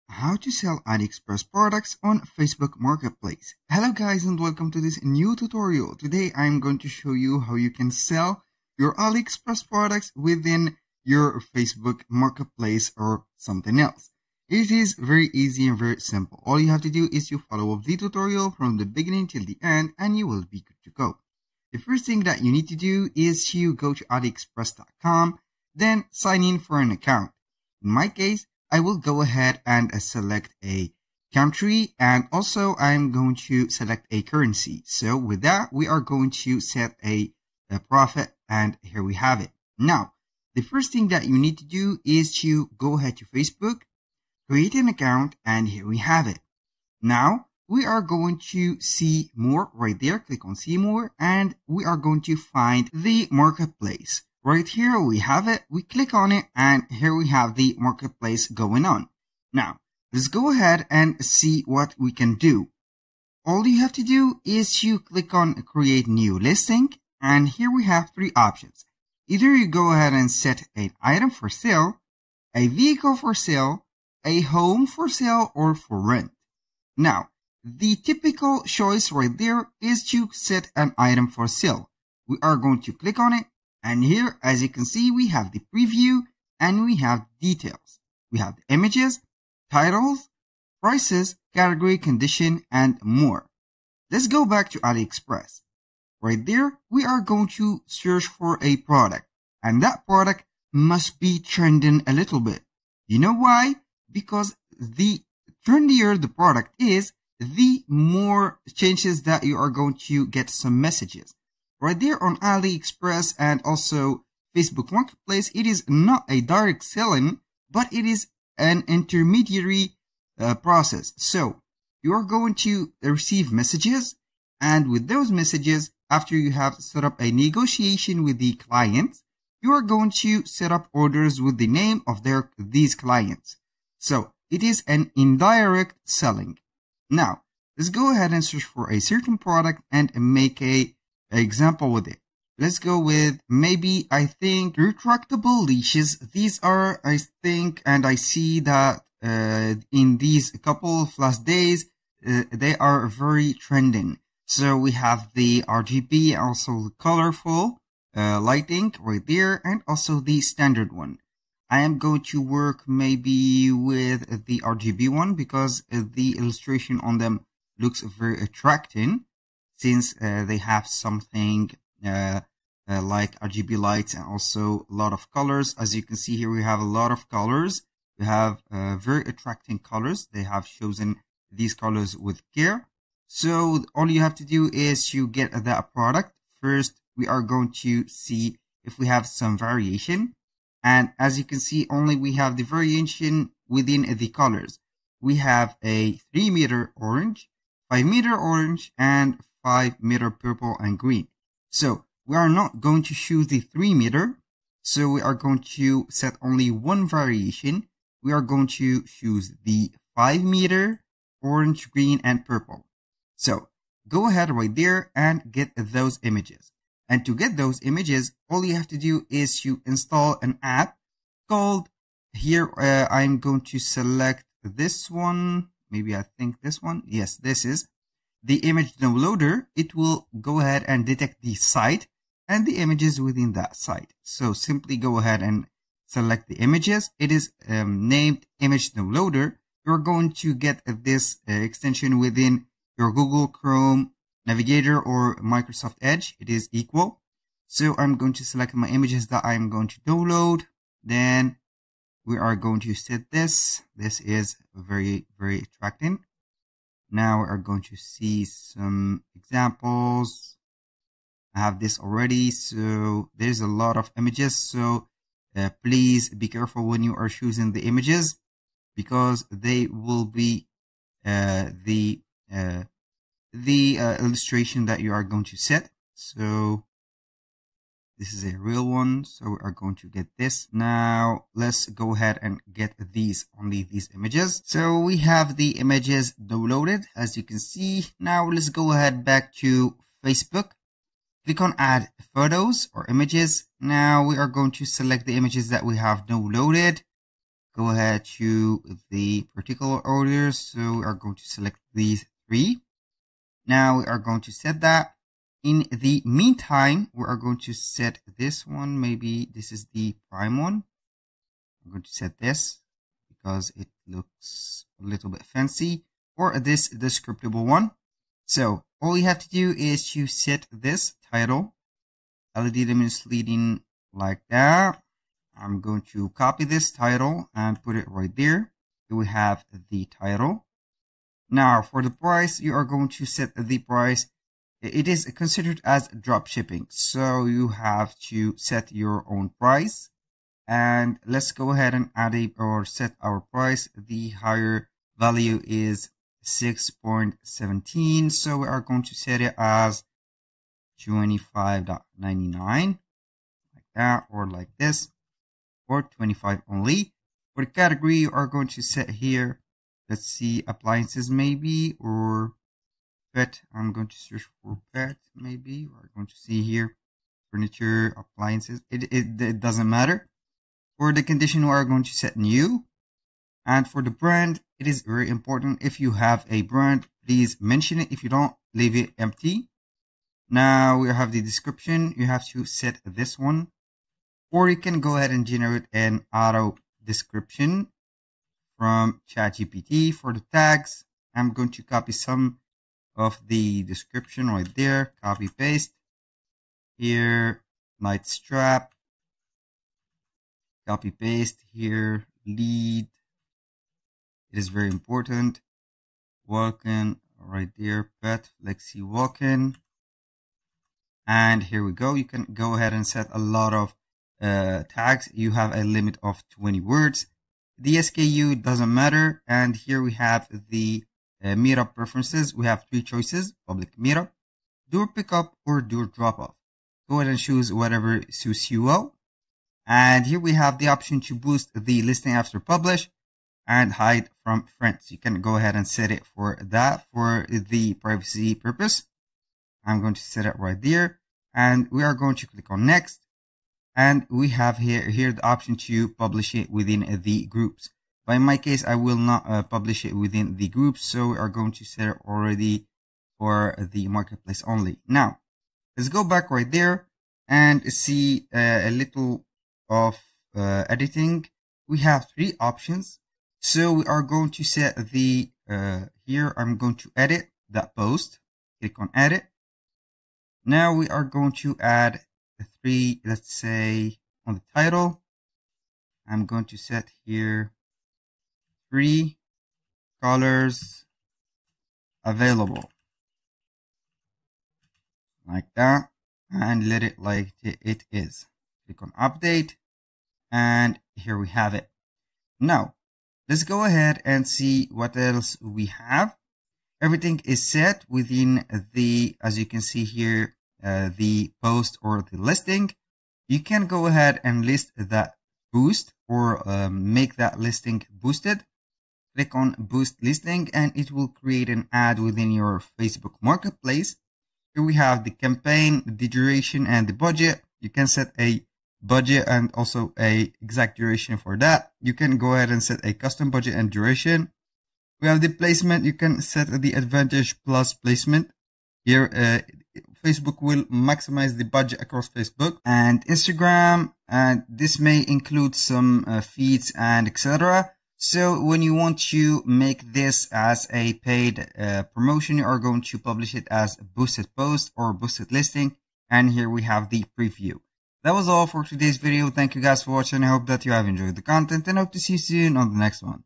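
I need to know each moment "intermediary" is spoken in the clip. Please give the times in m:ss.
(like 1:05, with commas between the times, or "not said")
1:58.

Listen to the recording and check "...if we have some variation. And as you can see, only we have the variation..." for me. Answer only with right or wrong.
right.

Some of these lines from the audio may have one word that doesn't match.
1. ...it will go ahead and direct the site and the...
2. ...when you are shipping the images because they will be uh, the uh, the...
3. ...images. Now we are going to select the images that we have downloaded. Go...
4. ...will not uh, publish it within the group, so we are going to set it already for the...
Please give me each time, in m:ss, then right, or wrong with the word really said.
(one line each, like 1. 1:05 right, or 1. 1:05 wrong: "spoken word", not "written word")
1. 3:49 wrong: "detect", not "direct"
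2. 4:26 wrong: "choosing", not "shipping"
3. 4:53 right
4. 7:28 right.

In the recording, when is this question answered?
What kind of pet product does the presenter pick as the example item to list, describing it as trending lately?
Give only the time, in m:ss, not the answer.
2:24.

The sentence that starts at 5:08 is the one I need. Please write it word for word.
Maybe this is the prime one.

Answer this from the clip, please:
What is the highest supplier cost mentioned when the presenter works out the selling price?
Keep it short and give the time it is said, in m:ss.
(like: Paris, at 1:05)
6.17, at 5:46.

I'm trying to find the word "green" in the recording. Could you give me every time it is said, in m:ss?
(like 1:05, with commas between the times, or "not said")
3:20, 3:31.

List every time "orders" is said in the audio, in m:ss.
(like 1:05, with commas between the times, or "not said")
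2:10, 5:00.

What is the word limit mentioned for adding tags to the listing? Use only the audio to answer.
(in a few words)
20 words.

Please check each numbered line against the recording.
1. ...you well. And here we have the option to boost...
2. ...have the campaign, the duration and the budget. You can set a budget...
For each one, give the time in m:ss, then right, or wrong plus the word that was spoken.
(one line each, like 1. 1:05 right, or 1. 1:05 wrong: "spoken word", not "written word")
1. 7:08 right
2. 8:34 right.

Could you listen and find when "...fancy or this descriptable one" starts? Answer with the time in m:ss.
5:15.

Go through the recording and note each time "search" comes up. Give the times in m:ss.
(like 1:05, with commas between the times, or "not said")
1:37, 2:18, 6:04.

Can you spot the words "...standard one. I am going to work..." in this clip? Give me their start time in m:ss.
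2:40.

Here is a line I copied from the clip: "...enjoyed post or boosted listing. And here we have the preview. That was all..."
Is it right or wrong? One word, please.
wrong.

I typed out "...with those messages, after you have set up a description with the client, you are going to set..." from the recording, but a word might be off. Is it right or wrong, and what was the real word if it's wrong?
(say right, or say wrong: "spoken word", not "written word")
wrong: "negotiation", not "description".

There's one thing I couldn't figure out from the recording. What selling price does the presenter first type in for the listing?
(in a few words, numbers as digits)
25.99.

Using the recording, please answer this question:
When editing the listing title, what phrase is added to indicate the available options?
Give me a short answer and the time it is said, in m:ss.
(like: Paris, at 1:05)
three colors available, at 7:58.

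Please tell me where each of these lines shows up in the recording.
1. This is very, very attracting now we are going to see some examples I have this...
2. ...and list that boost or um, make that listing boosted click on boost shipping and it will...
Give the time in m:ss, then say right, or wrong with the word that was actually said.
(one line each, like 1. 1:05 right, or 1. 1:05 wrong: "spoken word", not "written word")
1. 4:13 right
2. 8:24 wrong: "listing", not "shipping".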